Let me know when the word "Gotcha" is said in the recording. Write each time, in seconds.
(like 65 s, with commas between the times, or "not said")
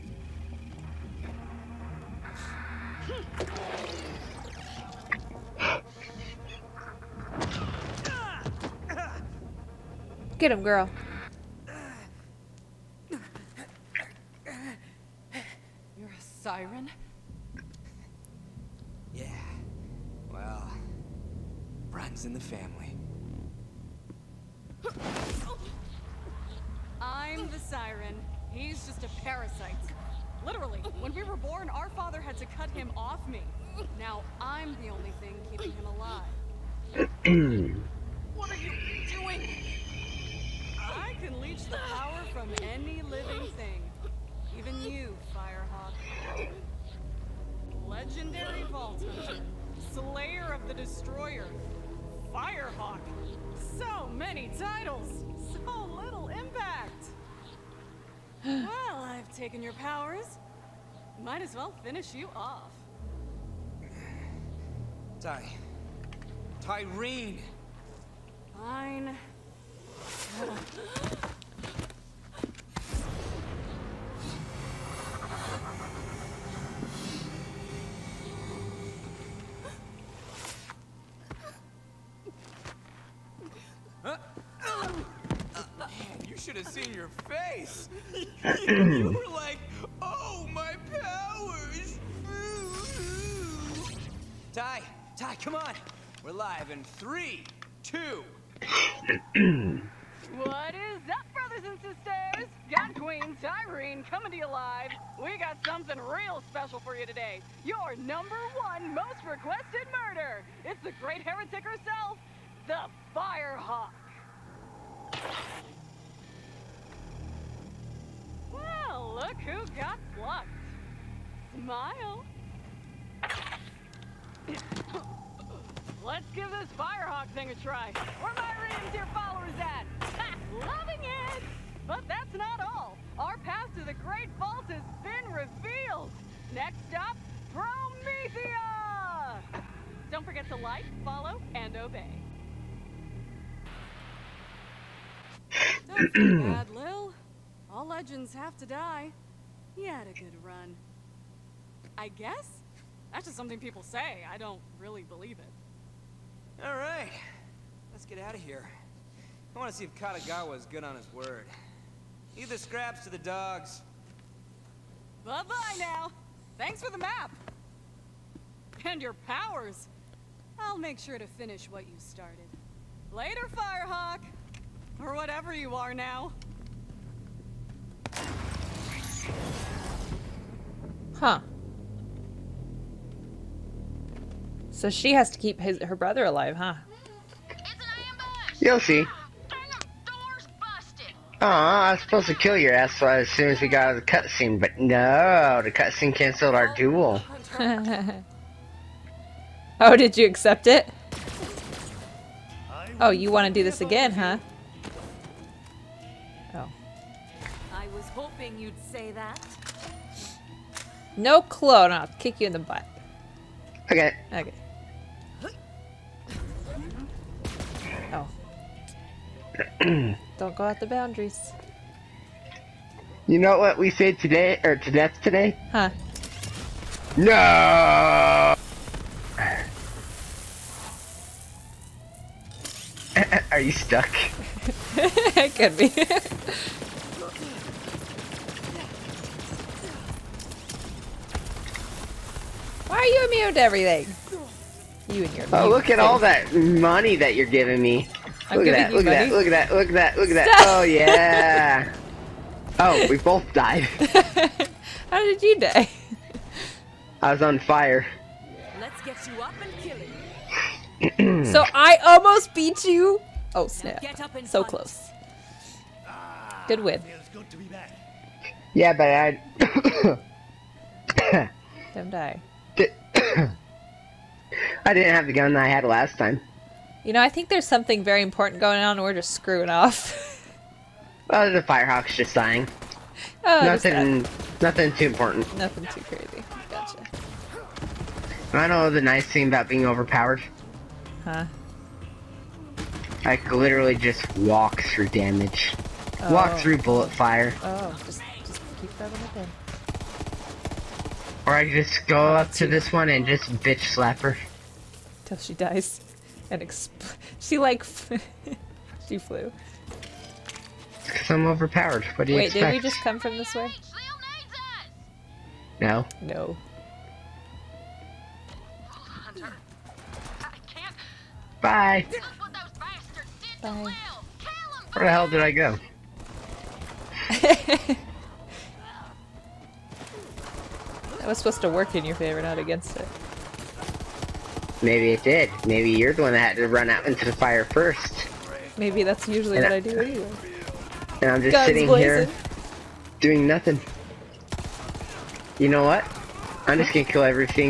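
286 s.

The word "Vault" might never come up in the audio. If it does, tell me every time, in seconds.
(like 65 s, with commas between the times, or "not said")
48 s, 134 s.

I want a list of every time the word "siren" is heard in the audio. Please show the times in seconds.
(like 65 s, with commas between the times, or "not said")
16 s, 27 s.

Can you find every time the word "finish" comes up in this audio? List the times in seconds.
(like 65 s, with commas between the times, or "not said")
61 s, 171 s.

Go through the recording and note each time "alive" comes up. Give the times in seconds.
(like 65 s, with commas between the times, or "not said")
35 s, 186 s.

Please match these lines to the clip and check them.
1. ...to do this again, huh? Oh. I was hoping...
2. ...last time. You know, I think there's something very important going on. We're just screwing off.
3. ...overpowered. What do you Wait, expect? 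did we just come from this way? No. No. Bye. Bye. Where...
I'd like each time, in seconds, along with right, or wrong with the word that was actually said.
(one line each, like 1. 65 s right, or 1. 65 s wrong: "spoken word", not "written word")
1. 203 s right
2. 275 s right
3. 311 s right.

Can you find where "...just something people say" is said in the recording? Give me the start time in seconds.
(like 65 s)
153 s.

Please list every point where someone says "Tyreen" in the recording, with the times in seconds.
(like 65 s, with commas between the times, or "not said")
66 s, 103 s.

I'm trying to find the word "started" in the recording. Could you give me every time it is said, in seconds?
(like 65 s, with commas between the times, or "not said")
171 s.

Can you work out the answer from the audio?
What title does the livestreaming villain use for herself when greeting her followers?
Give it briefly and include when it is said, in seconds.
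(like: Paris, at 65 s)
Gun Queen, at 102 s.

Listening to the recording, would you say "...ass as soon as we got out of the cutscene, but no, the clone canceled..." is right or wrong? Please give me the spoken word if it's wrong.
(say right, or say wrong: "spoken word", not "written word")
wrong: "cutscene", not "clone".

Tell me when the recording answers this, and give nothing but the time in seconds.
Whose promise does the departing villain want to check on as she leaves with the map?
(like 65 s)
159 s.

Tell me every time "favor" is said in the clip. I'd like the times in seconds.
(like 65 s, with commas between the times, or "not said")
332 s.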